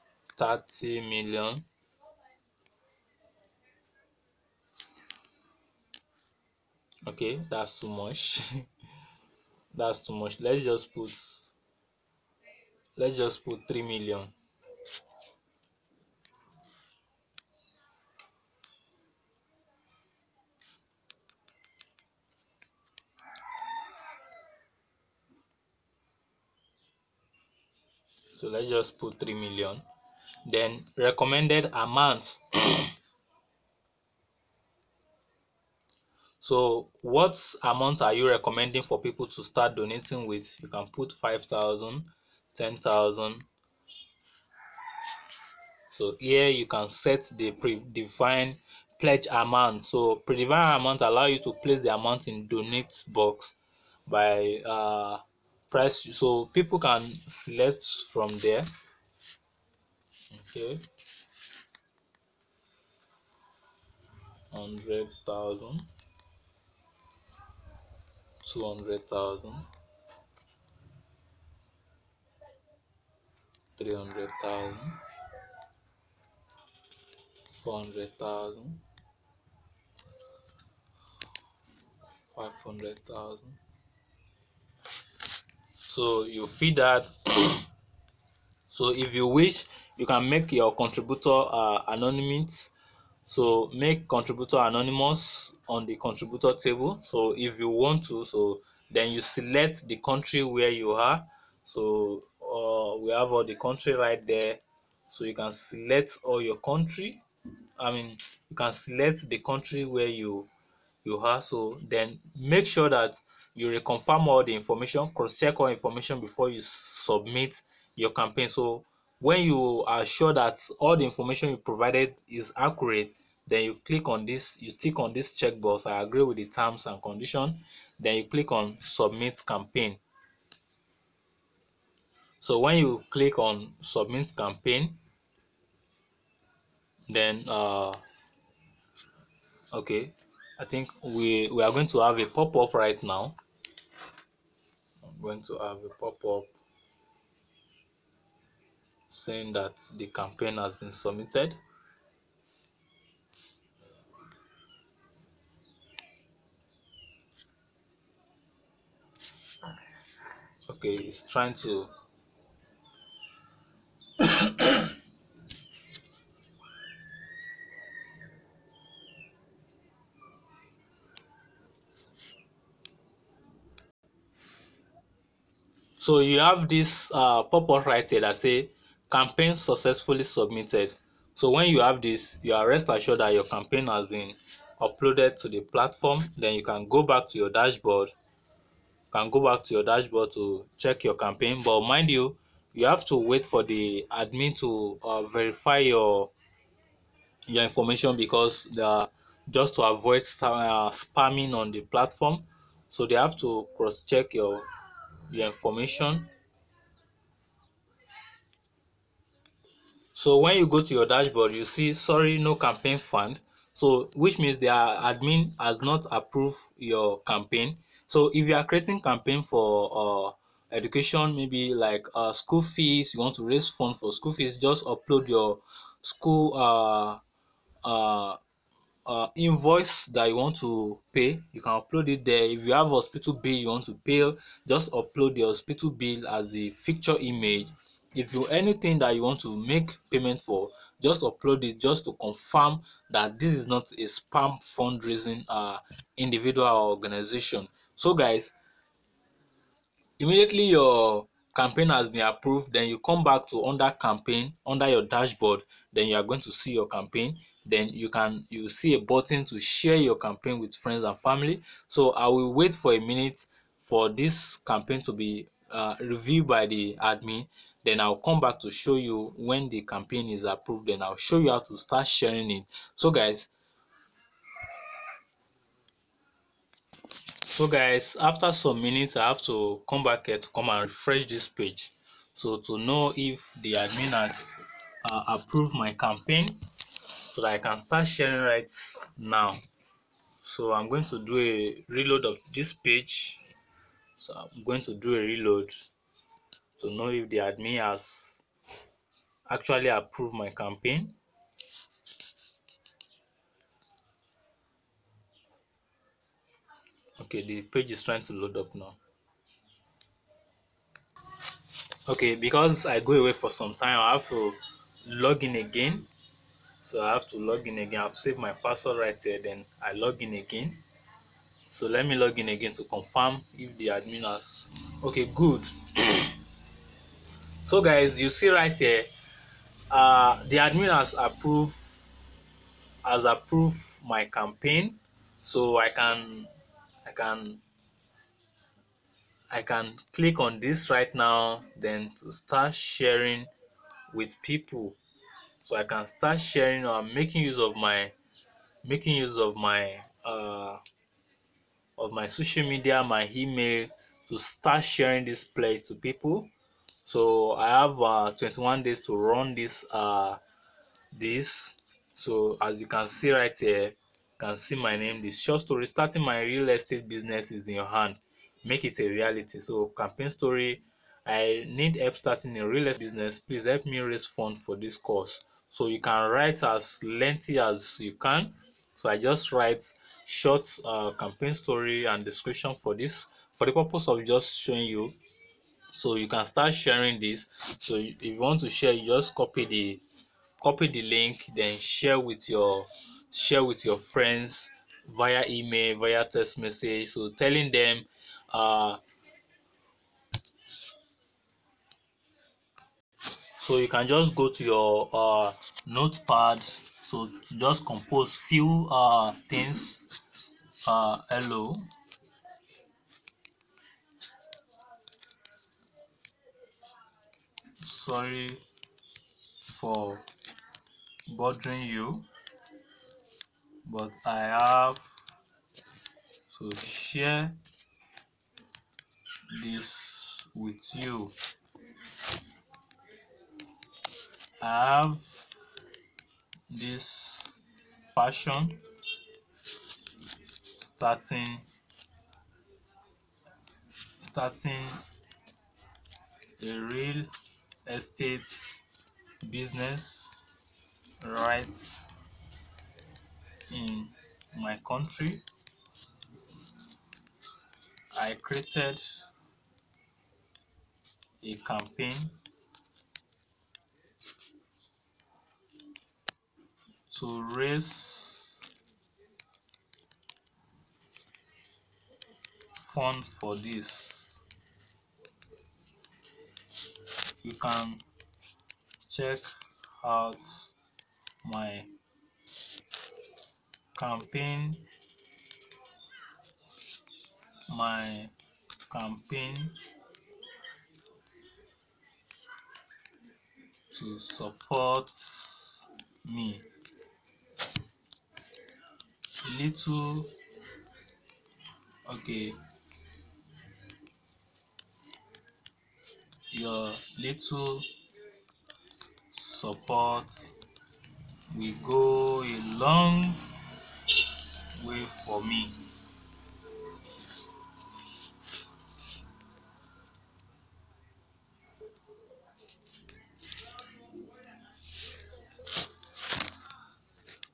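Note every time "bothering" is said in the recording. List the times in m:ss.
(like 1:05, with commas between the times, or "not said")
7:01.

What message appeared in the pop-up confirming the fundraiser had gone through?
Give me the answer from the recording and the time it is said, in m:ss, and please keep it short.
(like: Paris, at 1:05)
campaign successfully submitted, at 2:59.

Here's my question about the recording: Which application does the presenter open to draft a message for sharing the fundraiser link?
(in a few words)
notepad.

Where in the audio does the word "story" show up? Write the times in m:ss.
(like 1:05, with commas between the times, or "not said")
6:05, 6:10, 6:21.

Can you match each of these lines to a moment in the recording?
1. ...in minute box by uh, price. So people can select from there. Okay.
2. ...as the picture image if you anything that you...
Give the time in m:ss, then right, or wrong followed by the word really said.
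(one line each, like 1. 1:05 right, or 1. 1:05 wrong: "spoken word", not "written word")
1. 0:52 wrong: "donate", not "minute"
2. 3:56 right.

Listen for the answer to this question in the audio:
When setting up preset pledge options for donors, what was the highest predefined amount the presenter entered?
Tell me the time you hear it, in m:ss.
1:22.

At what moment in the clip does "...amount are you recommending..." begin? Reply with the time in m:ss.
0:37.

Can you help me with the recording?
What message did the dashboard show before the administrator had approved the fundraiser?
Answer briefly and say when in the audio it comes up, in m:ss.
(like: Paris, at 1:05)
sorry no campaign fund, at 3:31.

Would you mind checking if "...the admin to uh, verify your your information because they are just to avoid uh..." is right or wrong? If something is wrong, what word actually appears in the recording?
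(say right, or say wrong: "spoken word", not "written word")
right.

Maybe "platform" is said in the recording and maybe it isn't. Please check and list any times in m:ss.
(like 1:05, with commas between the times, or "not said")
3:05, 3:21.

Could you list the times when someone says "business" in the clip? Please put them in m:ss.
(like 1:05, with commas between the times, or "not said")
6:07, 6:13, 7:29.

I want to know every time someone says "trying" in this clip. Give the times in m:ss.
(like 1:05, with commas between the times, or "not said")
2:41, 5:08.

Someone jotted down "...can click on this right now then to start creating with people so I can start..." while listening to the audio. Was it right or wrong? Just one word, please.
wrong.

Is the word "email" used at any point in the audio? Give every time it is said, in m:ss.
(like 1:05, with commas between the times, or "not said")
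5:53, 6:35.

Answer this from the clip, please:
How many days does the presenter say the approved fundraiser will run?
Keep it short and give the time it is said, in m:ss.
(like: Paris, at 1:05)
21 days, at 5:58.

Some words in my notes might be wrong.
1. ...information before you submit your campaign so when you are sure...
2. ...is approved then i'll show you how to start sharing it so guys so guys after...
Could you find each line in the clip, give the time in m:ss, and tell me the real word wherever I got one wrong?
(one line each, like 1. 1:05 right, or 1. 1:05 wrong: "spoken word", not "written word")
1. 1:55 right
2. 4:30 right.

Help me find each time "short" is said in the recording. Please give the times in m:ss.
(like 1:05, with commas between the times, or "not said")
6:05, 6:20.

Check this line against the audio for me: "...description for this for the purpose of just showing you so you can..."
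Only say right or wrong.
right.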